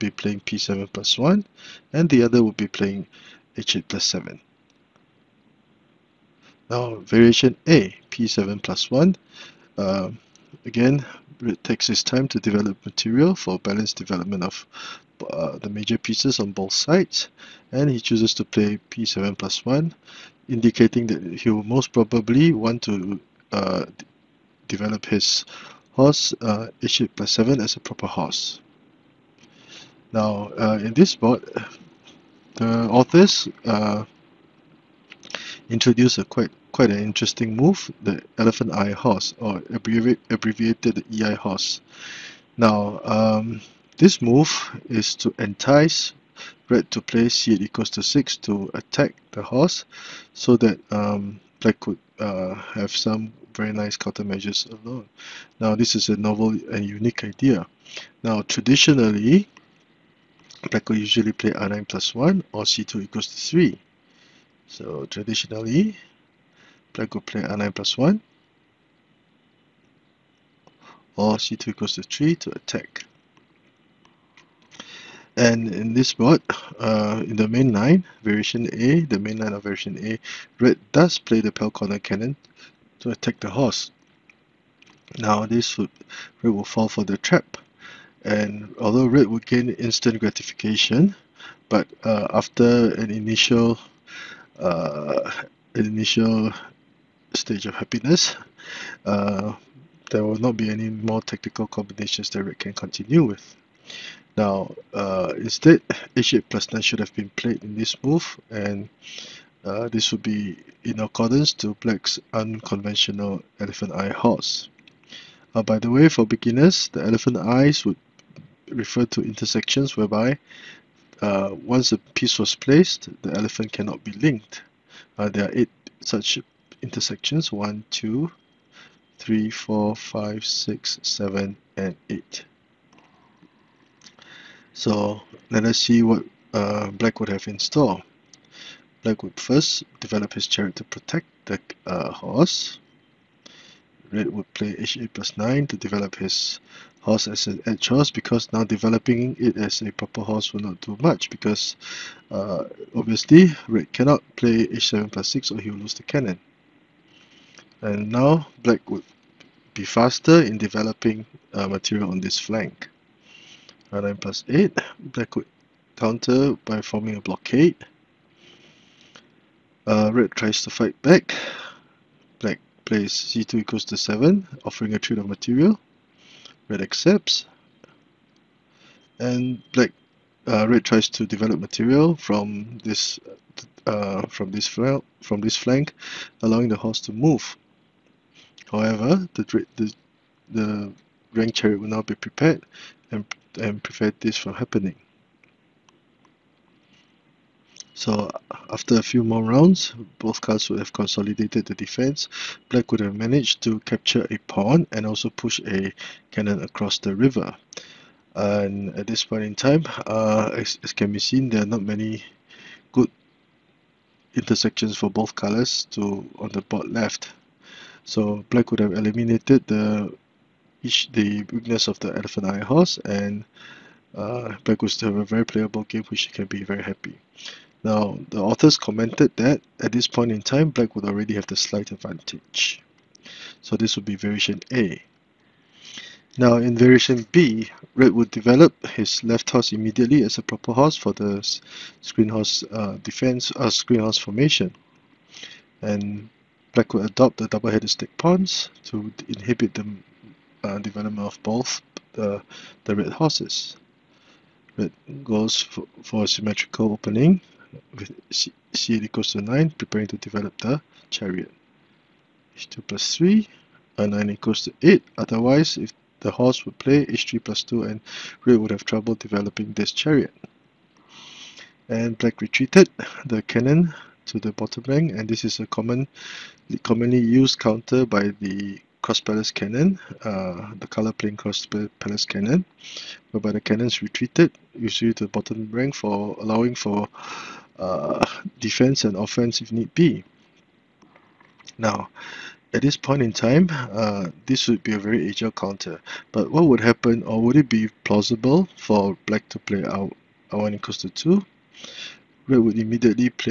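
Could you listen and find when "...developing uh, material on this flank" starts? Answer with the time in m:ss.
2:40.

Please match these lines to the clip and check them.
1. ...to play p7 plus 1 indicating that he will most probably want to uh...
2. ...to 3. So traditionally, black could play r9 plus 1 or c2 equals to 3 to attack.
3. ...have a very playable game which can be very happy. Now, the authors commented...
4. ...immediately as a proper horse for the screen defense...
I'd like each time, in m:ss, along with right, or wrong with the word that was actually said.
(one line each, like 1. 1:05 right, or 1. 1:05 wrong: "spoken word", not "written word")
1. 0:18 right
2. 1:03 right
3. 3:45 right
4. 3:59 wrong: "horse", not "defense".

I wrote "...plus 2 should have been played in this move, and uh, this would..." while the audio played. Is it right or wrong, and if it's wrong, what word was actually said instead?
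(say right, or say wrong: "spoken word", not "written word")
wrong: "9", not "2".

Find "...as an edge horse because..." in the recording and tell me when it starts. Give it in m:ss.
2:27.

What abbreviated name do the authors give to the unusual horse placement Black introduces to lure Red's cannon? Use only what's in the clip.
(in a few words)
EI horse.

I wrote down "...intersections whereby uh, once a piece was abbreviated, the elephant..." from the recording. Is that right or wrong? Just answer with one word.
wrong.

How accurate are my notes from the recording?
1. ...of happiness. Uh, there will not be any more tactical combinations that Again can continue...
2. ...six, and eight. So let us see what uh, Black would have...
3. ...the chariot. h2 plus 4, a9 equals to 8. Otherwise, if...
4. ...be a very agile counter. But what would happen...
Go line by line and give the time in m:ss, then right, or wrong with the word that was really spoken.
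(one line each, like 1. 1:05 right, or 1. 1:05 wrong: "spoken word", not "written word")
1. 1:37 wrong: "Red", not "Again"
2. 2:11 wrong: "seven", not "six"
3. 4:20 wrong: "3", not "4"
4. 4:54 right.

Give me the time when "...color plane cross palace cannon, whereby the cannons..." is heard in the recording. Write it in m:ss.
4:40.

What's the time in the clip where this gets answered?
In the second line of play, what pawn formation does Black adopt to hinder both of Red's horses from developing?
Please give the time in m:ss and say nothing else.
4:07.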